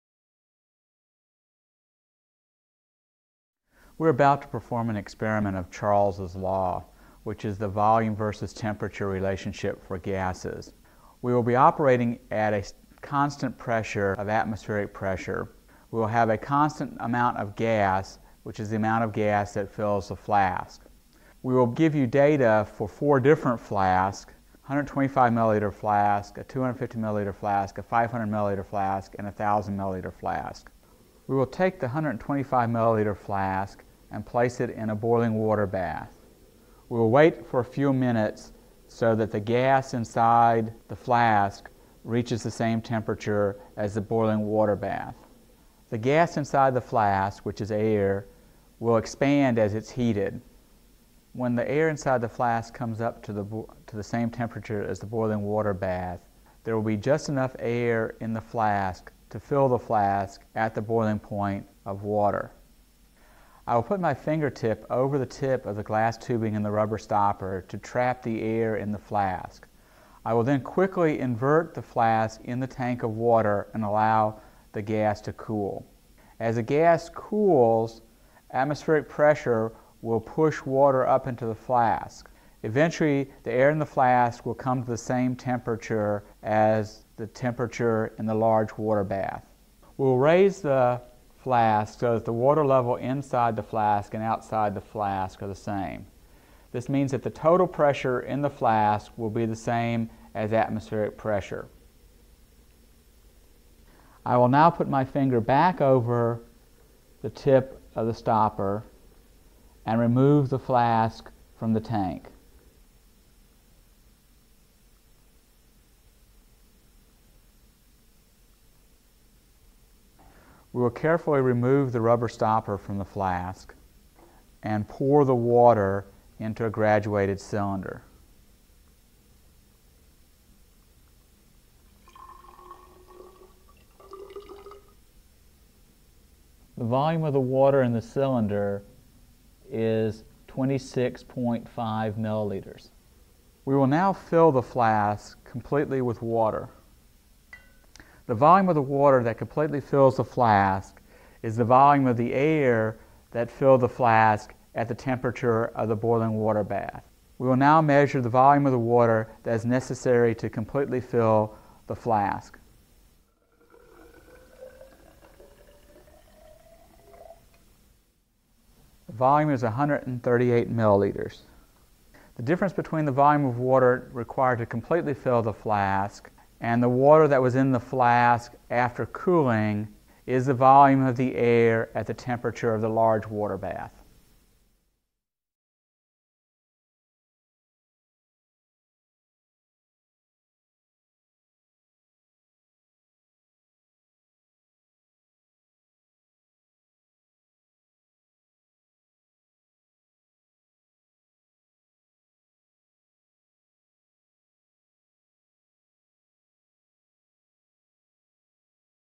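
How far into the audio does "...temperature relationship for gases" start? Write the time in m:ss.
0:08.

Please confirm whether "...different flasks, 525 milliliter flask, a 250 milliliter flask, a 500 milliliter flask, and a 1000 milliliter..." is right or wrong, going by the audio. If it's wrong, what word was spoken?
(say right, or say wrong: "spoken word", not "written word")
wrong: "125", not "525".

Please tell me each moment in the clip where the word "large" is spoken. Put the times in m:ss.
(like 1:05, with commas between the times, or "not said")
1:28, 3:02.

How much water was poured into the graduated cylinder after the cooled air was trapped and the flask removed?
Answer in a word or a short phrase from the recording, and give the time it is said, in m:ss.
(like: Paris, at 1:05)
26.5 milliliters, at 2:20.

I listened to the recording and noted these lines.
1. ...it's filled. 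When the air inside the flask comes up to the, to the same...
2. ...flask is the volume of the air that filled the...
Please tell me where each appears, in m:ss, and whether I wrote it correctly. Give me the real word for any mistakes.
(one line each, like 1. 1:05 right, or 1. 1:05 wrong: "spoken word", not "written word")
1. 0:49 wrong: "heated", not "filled"
2. 2:30 right.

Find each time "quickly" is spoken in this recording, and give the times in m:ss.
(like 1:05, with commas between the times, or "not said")
1:10.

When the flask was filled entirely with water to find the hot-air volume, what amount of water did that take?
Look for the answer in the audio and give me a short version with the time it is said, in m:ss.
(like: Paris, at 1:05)
138 milliliters, at 2:49.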